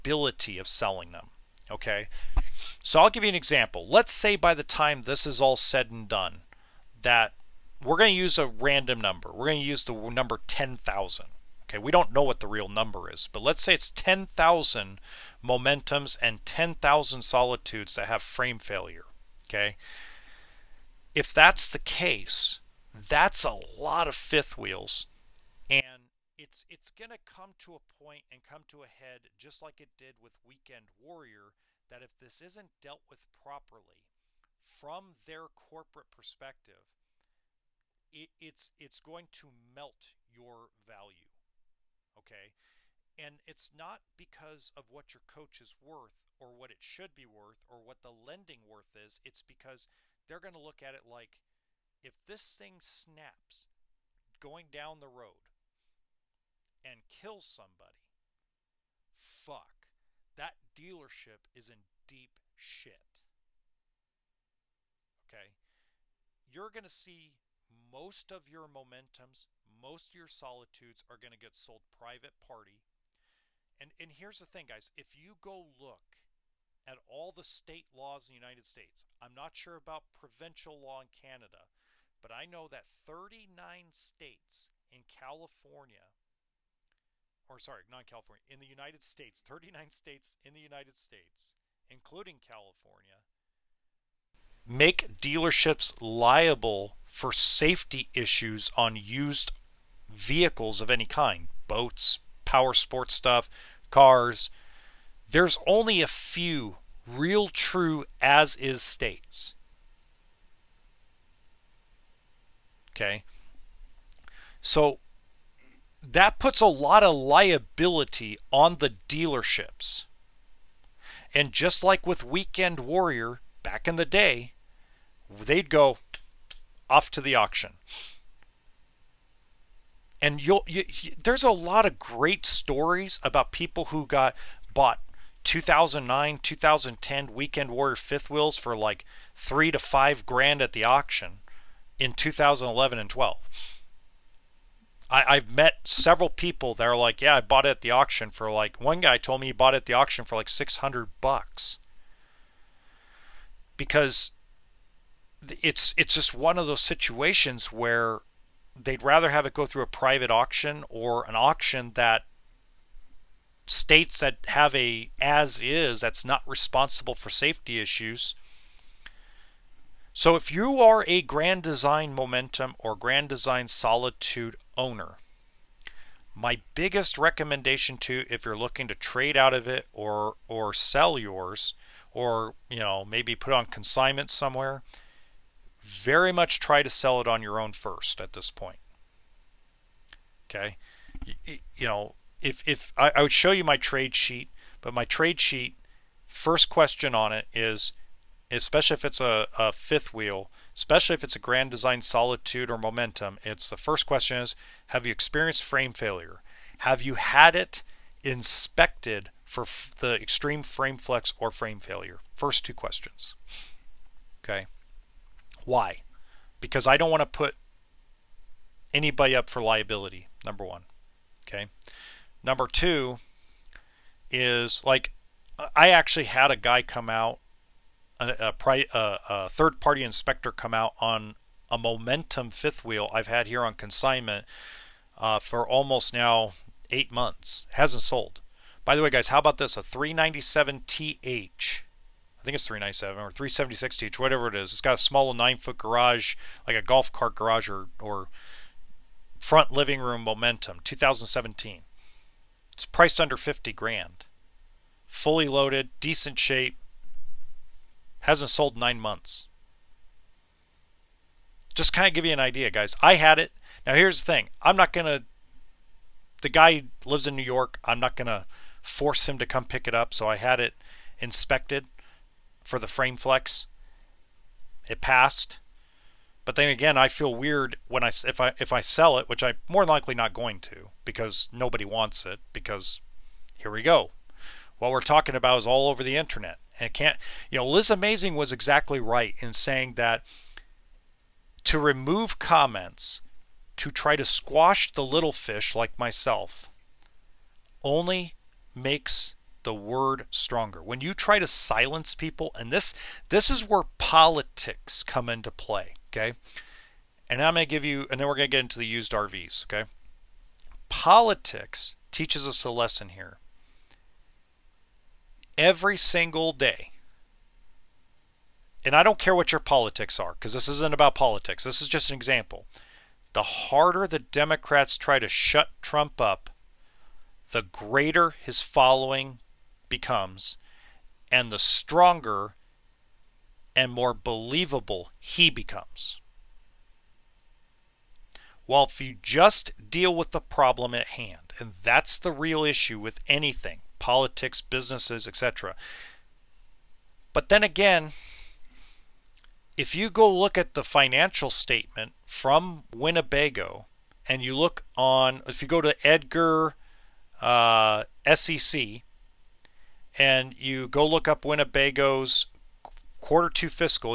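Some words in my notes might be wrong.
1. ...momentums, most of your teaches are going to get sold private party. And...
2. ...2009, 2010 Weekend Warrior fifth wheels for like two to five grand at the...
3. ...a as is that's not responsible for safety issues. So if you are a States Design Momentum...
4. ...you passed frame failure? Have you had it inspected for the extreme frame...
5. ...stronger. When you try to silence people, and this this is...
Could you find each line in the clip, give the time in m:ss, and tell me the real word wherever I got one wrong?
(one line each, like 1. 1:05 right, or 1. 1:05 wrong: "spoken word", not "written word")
1. 1:08 wrong: "solitudes", not "teaches"
2. 2:15 wrong: "three", not "two"
3. 2:44 wrong: "Grand", not "States"
4. 3:25 wrong: "experienced", not "passed"
5. 5:00 right.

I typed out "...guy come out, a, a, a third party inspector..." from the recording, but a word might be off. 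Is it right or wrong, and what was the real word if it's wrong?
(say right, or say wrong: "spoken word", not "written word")
right.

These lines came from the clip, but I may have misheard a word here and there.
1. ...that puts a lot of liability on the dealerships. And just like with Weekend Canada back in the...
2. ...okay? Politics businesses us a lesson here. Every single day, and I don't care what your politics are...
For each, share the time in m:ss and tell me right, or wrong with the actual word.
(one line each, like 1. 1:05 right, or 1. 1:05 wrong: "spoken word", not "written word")
1. 1:56 wrong: "Warrior", not "Canada"
2. 5:09 wrong: "teaches", not "businesses".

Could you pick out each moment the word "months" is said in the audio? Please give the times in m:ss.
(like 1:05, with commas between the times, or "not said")
3:57, 4:19.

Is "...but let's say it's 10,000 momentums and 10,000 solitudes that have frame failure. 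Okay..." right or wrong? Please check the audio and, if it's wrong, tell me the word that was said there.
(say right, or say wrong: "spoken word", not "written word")
right.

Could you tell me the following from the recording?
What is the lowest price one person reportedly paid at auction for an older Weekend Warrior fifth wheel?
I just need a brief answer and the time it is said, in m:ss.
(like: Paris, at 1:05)
600 bucks, at 2:30.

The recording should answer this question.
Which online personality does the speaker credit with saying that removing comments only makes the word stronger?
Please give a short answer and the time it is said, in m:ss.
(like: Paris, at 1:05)
Liz Amazing, at 4:47.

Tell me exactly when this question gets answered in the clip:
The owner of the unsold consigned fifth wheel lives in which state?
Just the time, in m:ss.
4:27.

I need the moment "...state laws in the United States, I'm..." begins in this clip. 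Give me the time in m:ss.
1:17.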